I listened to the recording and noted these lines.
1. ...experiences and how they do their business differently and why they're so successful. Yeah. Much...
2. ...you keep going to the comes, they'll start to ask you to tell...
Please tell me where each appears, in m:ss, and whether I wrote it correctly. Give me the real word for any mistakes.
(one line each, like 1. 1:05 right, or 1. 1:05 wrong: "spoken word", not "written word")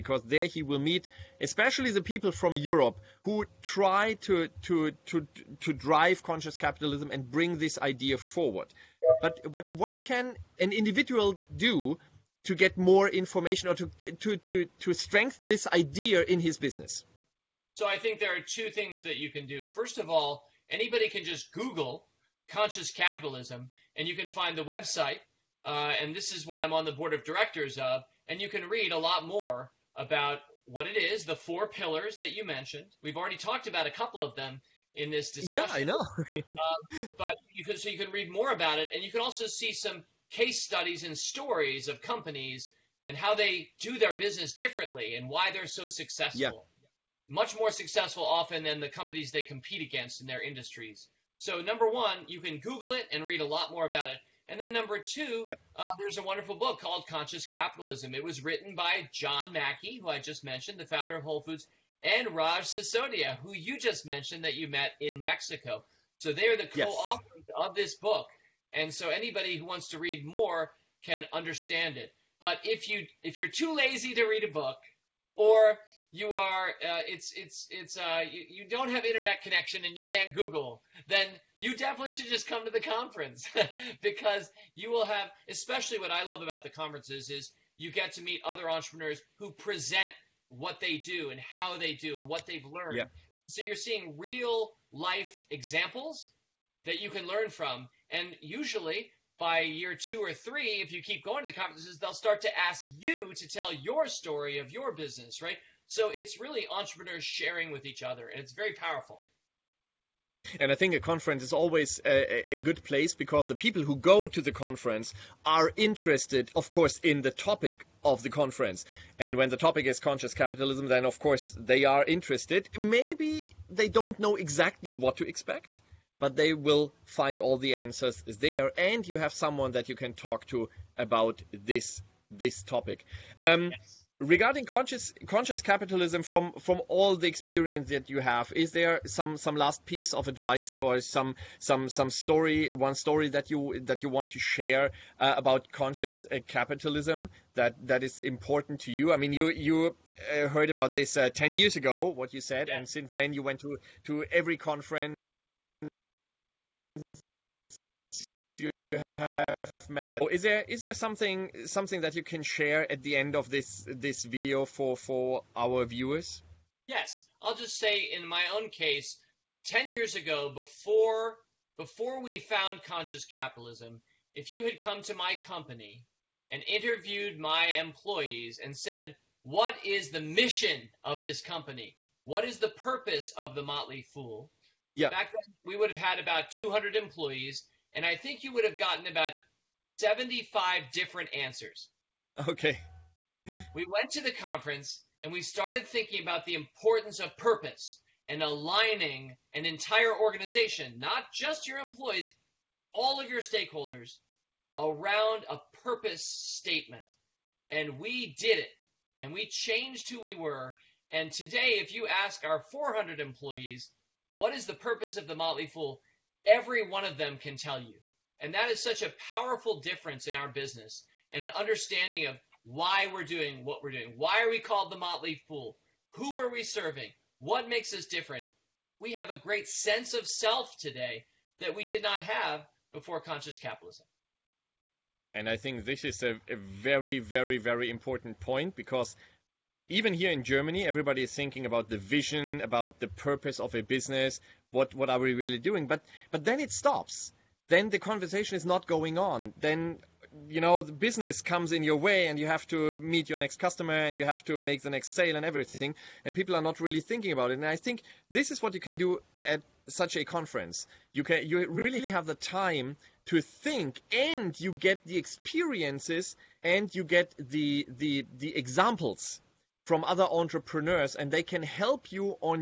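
1. 0:42 wrong: "companies", not "experiences"
2. 1:40 wrong: "conferences", not "comes".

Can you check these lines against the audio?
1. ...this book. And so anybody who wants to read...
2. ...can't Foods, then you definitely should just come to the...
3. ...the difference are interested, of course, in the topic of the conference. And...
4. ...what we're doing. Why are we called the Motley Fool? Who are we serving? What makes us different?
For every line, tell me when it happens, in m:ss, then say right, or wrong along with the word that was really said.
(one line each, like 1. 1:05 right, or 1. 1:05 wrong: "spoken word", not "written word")
1. 1:07 right
2. 1:20 wrong: "Google", not "Foods"
3. 1:54 wrong: "conference", not "difference"
4. 3:43 right.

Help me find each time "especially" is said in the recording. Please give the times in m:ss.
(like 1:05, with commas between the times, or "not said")
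0:01, 1:25.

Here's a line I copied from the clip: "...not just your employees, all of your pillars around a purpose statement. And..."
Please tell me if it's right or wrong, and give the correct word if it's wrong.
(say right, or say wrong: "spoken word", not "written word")
wrong: "stakeholders", not "pillars".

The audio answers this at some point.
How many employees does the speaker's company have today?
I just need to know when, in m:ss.
3:32.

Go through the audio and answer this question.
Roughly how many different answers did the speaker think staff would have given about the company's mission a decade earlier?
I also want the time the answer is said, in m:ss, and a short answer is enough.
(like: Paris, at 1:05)
75, at 3:09.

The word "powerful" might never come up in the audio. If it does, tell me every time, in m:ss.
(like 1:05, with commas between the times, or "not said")
1:48, 3:39.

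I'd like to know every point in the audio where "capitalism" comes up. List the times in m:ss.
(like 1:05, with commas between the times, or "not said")
0:06, 0:22, 0:57, 2:00, 2:15, 2:26, 2:53, 3:53.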